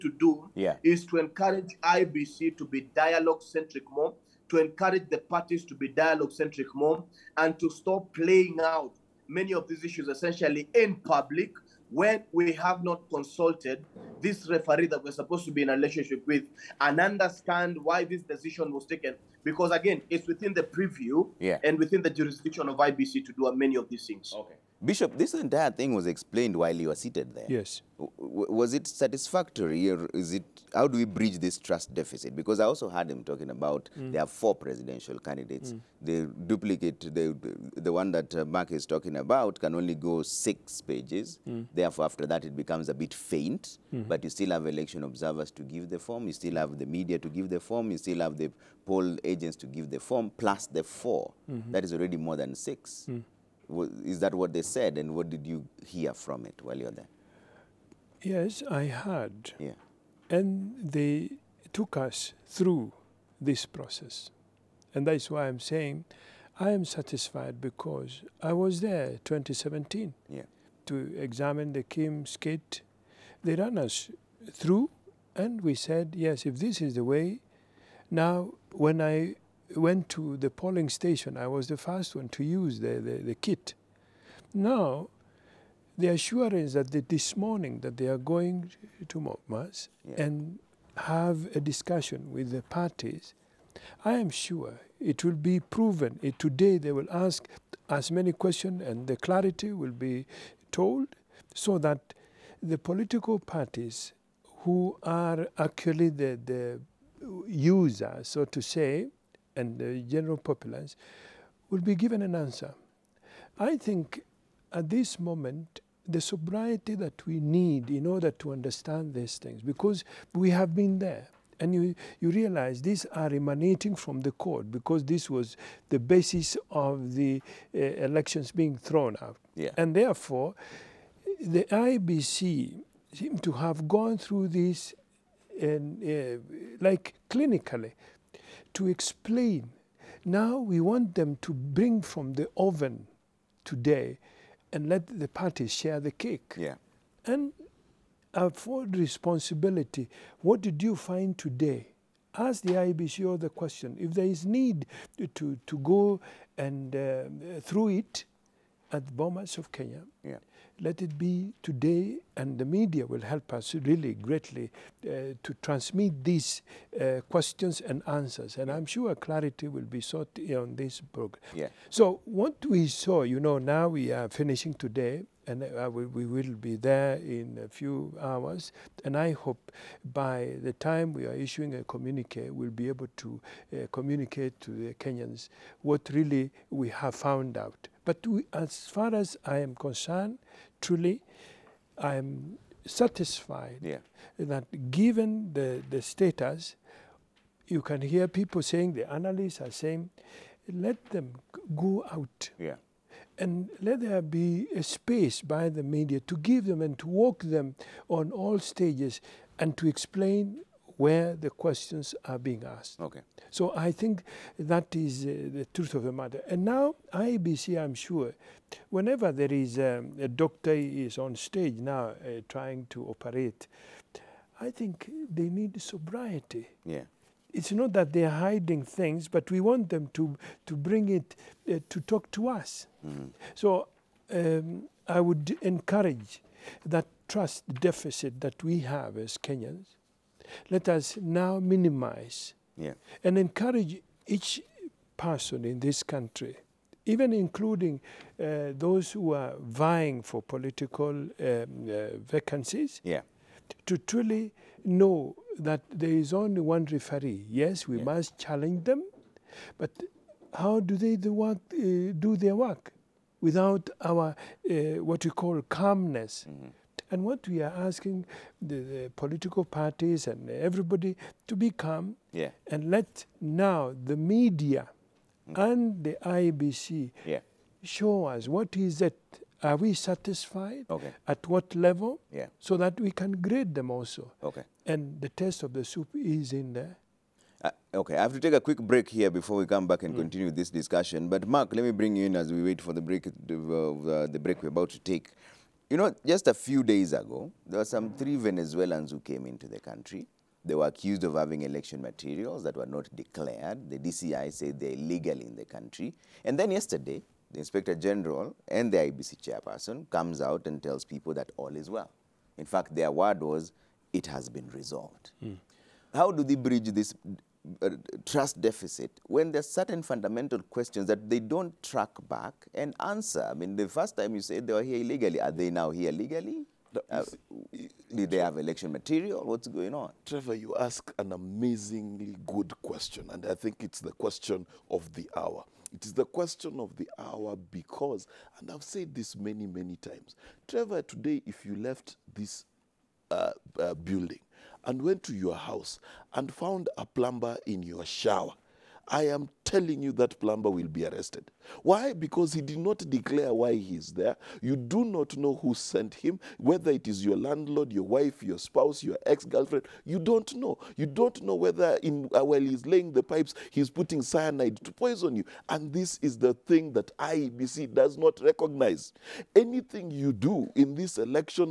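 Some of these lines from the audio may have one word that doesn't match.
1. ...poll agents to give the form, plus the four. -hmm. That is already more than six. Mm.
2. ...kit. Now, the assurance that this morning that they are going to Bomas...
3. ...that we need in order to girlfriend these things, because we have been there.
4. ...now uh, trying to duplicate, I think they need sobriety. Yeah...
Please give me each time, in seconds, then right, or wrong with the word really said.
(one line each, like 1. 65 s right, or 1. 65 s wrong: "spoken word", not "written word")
1. 48 s right
2. 83 s right
3. 116 s wrong: "understand", not "girlfriend"
4. 221 s wrong: "operate", not "duplicate".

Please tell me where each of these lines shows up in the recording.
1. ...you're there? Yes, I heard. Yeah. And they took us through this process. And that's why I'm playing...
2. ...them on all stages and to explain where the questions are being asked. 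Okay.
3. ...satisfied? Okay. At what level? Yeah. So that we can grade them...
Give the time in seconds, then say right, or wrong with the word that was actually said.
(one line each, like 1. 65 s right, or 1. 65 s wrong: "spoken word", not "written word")
1. 56 s wrong: "saying", not "playing"
2. 207 s right
3. 279 s right.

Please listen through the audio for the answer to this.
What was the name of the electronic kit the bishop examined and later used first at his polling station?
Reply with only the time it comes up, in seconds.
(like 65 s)
71 s.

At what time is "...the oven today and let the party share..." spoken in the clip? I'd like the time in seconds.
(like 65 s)
142 s.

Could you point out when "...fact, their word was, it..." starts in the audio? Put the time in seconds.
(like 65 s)
312 s.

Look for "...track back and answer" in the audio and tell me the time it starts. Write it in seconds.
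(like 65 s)
321 s.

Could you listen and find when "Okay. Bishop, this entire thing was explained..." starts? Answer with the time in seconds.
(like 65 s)
24 s.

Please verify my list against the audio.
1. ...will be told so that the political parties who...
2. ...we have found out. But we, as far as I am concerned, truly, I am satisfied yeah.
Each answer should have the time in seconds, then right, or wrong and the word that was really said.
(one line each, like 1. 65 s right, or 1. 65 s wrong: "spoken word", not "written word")
1. 99 s right
2. 186 s right.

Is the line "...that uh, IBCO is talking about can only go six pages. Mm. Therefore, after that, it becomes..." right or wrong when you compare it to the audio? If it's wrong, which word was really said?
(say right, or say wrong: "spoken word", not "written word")
wrong: "Mark", not "IBCO".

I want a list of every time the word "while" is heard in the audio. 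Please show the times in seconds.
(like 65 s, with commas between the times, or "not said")
26 s, 56 s, 362 s.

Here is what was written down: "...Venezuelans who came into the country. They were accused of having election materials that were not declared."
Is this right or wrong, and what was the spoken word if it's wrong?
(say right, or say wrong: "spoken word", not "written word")
right.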